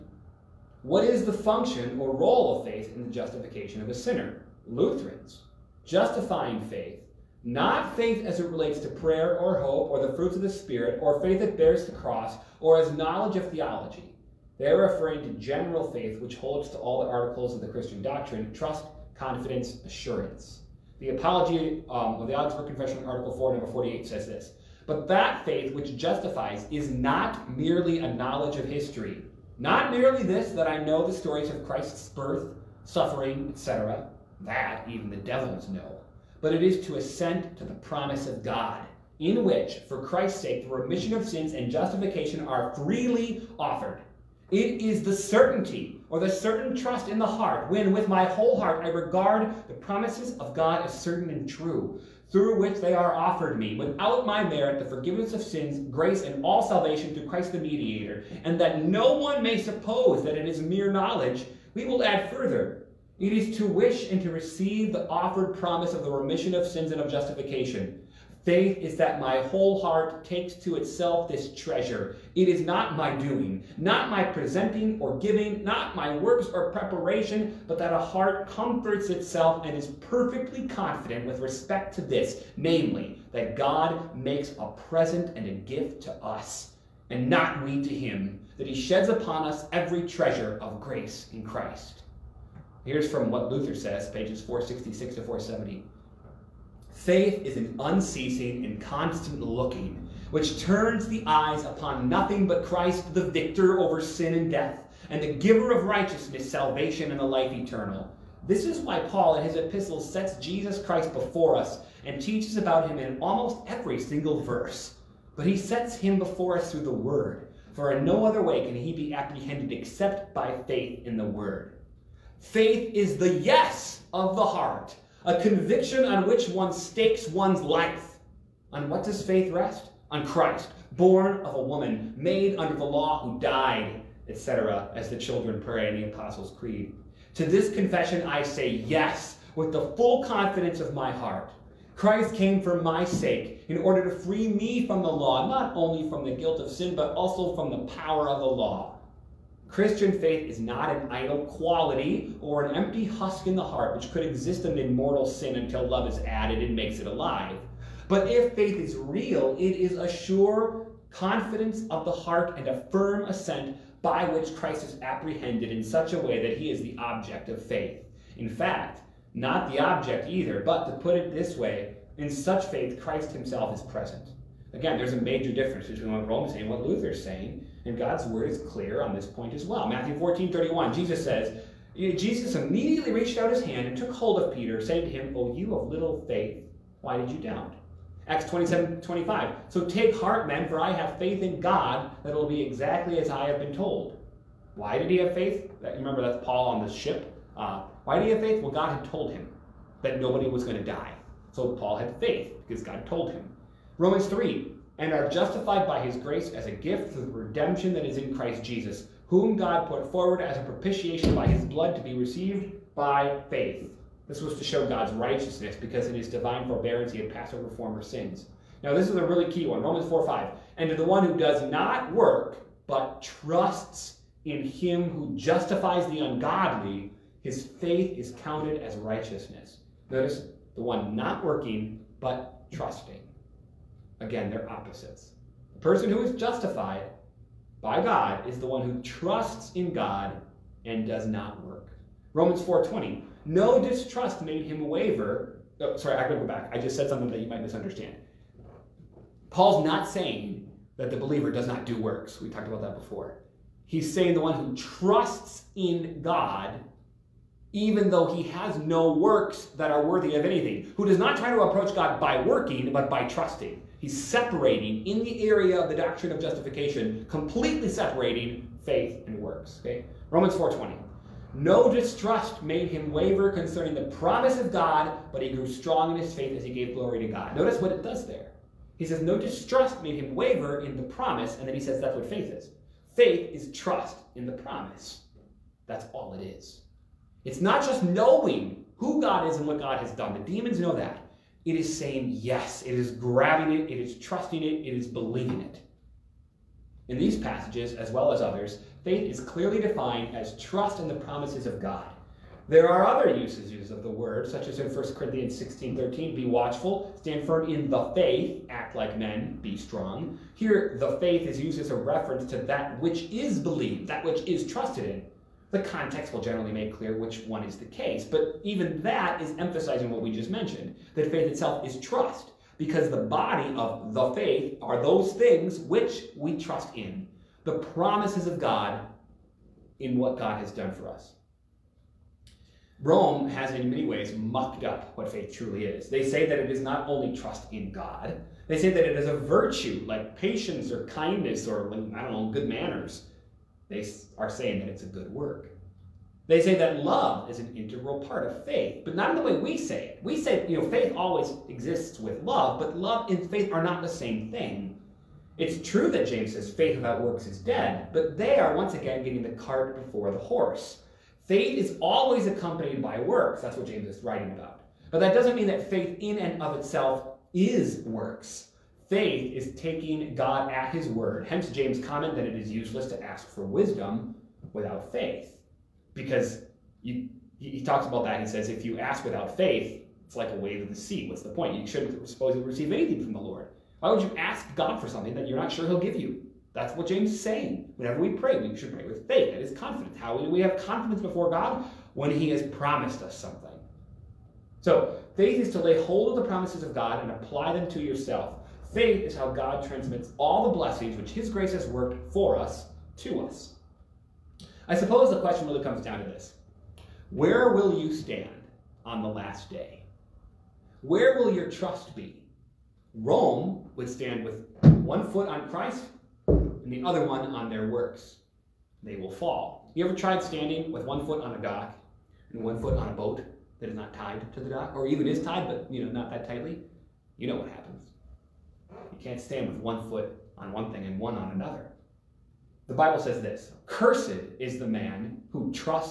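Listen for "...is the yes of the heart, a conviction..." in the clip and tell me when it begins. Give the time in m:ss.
2:02.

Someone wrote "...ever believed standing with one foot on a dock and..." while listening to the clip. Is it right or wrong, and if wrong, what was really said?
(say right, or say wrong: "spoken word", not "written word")
wrong: "tried", not "believed".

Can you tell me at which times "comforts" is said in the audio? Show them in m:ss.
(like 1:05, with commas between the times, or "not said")
1:18.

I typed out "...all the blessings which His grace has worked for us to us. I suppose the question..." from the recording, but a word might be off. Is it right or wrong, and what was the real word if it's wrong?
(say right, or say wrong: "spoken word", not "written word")
right.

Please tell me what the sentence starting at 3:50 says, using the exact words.
Notice the one not working, but trusting.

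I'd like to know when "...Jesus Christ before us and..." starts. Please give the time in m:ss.
1:50.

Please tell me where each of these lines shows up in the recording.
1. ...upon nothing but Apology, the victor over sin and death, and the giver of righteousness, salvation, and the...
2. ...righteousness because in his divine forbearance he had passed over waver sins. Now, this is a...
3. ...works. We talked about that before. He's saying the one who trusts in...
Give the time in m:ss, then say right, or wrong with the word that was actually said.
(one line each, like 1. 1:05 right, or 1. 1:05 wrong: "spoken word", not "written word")
1. 1:41 wrong: "Christ", not "Apology"
2. 3:35 wrong: "former", not "waver"
3. 4:12 right.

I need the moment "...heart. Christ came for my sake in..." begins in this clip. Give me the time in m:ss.
2:21.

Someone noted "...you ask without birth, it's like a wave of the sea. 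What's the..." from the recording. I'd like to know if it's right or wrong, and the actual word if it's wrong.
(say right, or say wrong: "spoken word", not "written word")
wrong: "faith", not "birth".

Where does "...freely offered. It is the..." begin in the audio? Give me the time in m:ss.
0:42.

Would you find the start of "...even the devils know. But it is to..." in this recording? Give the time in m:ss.
0:34.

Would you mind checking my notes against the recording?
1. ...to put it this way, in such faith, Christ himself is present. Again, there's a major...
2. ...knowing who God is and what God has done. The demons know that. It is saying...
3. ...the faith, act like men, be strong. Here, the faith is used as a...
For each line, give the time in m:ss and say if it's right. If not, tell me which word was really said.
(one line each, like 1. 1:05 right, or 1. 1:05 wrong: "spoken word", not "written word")
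1. 2:50 right
2. 4:48 right
3. 5:07 right.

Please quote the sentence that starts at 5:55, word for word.
It's true that James says faith without works is dead, but they are once again getting the cart before the horse.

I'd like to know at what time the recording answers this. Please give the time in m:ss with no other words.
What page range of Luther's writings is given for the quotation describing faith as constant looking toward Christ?
1:34.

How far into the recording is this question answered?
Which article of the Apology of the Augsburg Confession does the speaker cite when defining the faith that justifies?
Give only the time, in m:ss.
0:23.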